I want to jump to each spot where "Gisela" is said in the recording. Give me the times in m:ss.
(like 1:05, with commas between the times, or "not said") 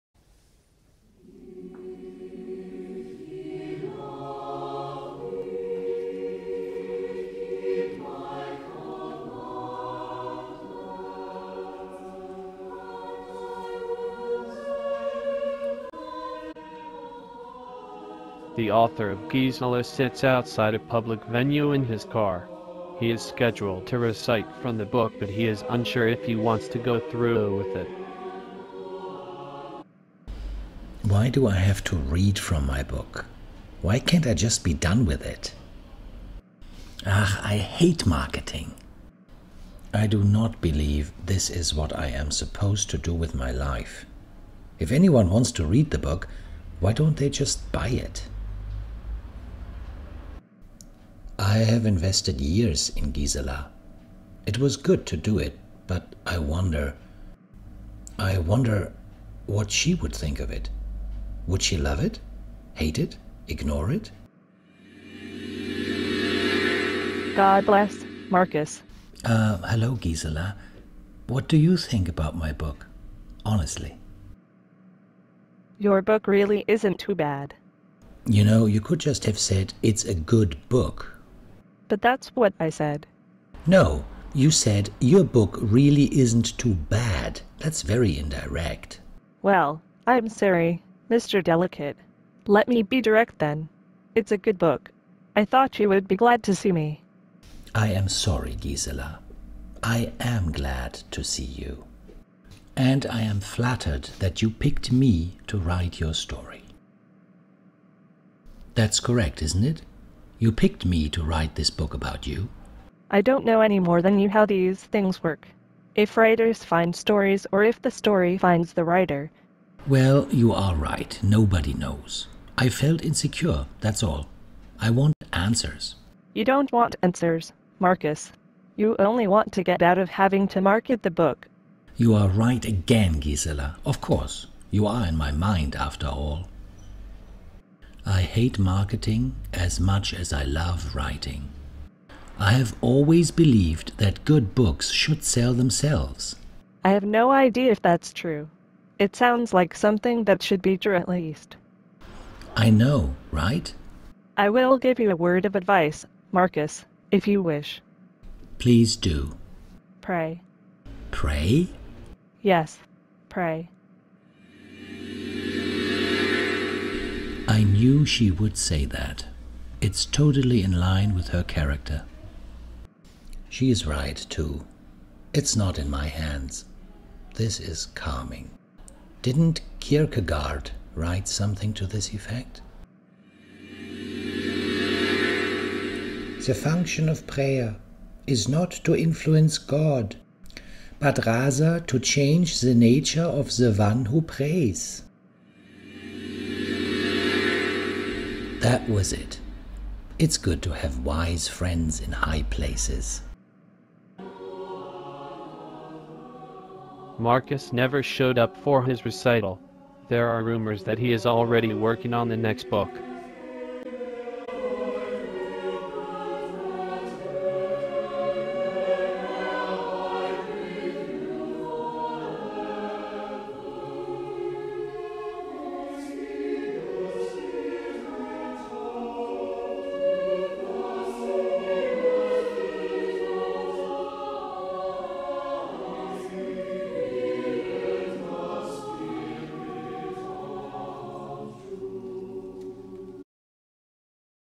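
0:19, 0:53, 1:09, 1:38, 2:13.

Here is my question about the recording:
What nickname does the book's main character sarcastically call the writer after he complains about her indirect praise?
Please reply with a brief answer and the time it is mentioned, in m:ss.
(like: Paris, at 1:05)
Mr. Delicate, at 1:31.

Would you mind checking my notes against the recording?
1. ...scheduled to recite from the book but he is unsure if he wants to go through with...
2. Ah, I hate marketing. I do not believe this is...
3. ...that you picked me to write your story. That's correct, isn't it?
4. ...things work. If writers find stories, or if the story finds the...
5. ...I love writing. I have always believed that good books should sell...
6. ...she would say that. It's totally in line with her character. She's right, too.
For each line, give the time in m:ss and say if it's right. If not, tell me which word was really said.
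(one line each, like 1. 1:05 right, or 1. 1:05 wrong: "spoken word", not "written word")
1. 0:23 right
2. 0:37 right
3. 1:44 right
4. 1:54 right
5. 2:20 right
6. 2:48 right.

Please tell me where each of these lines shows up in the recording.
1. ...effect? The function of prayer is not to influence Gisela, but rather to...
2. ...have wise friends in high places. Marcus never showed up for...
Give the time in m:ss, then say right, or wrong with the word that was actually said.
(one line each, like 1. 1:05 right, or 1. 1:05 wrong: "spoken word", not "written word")
1. 3:02 wrong: "God", not "Gisela"
2. 3:20 right.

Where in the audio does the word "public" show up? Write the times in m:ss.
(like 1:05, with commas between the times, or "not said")
0:20.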